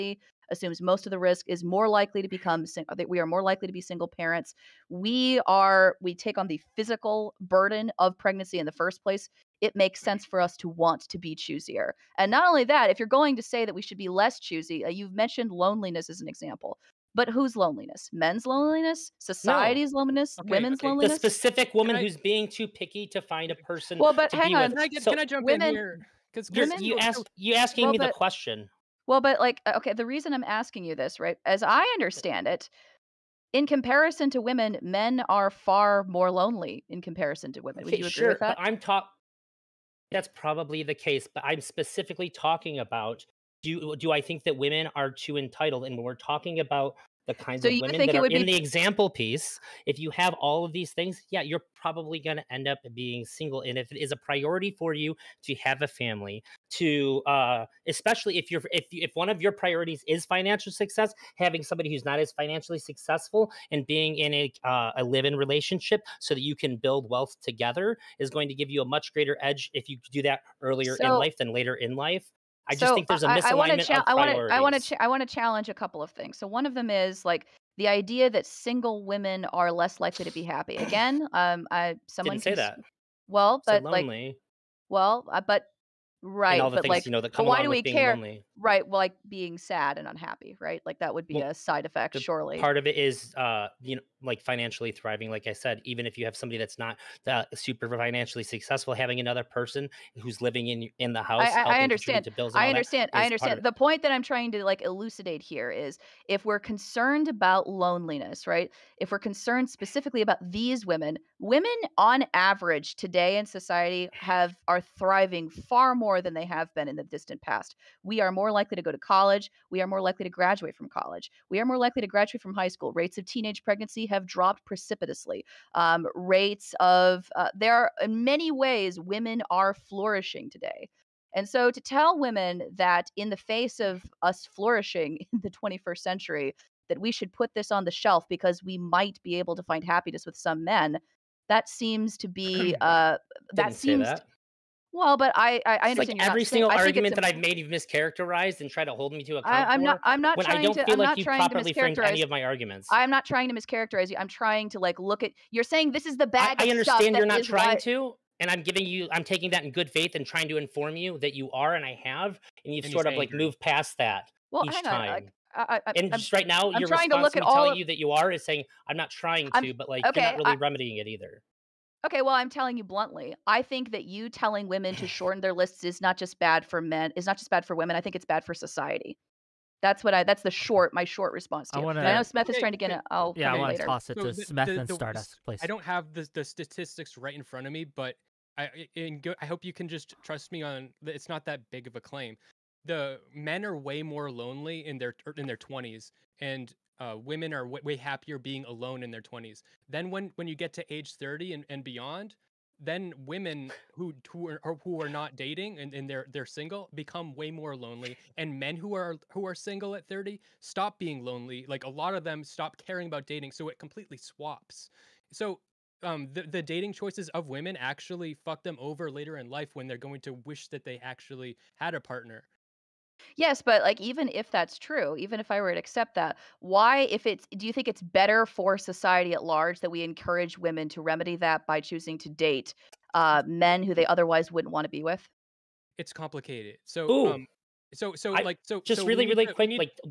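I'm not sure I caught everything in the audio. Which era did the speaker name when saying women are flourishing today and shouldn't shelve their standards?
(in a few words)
21st century.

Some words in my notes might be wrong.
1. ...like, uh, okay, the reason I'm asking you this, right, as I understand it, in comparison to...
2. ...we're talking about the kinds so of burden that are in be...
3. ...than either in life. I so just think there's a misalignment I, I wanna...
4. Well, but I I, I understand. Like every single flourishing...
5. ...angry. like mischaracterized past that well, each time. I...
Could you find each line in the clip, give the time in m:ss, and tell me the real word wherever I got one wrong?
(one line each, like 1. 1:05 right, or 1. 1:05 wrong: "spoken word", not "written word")
1. 0:29 right
2. 0:46 wrong: "women", not "burden"
3. 1:11 wrong: "later", not "either"
4. 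2:24 wrong: "saying", not "flourishing"
5. 2:43 wrong: "moved", not "mischaracterized".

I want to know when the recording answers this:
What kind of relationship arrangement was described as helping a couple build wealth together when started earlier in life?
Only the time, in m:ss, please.
1:05.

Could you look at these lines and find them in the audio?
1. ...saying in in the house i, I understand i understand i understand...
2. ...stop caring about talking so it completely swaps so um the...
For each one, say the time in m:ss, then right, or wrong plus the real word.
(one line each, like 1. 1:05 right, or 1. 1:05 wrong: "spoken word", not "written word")
1. 1:40 wrong: "living", not "saying"
2. 3:32 wrong: "dating", not "talking".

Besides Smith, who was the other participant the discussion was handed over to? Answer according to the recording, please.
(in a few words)
Stardust.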